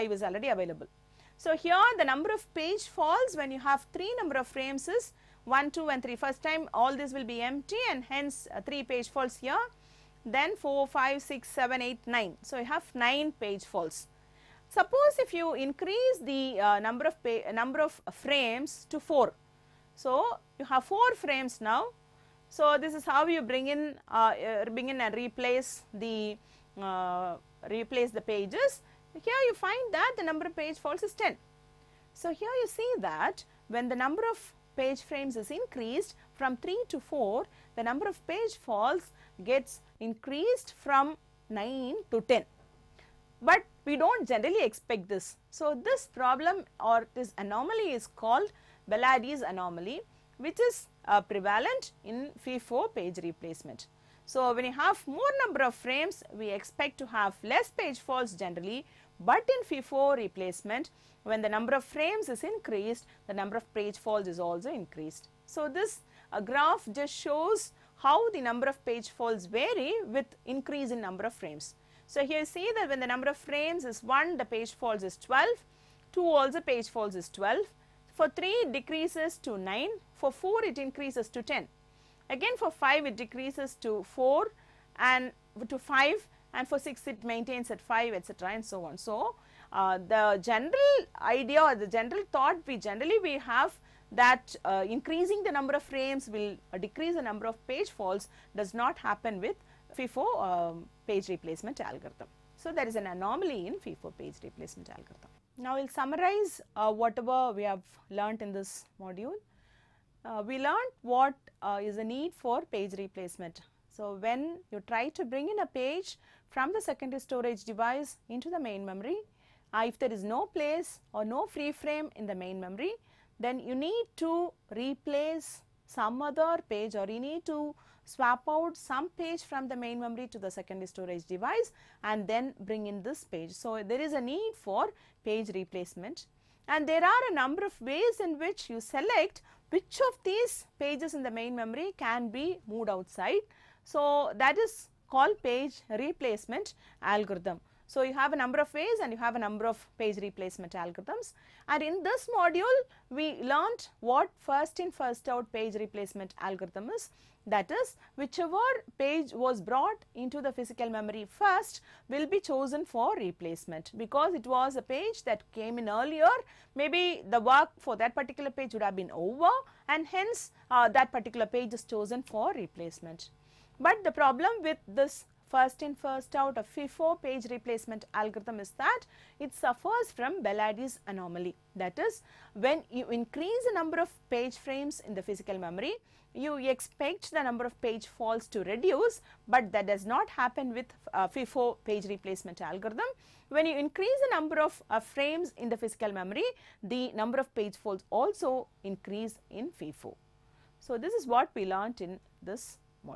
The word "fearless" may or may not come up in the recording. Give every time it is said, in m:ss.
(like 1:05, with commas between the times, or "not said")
not said.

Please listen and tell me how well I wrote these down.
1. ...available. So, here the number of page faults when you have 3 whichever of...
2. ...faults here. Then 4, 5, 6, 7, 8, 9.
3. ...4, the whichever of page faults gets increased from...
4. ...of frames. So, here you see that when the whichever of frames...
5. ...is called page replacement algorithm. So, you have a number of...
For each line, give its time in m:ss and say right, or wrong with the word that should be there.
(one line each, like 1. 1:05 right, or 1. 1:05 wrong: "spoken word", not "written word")
1. 0:00 wrong: "number", not "whichever"
2. 0:09 right
3. 0:36 wrong: "number", not "whichever"
4. 1:11 wrong: "number", not "whichever"
5. 2:24 right.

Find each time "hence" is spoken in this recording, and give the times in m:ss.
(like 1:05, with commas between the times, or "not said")
0:08, 2:50.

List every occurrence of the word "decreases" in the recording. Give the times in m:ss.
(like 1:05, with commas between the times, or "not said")
1:18, 1:23, 1:36.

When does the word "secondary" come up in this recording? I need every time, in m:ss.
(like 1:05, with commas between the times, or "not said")
1:56, 2:10.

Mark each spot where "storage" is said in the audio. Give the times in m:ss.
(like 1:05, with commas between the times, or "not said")
1:57, 2:10.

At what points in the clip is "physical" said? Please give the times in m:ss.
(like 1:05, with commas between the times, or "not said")
2:40, 3:05, 3:15.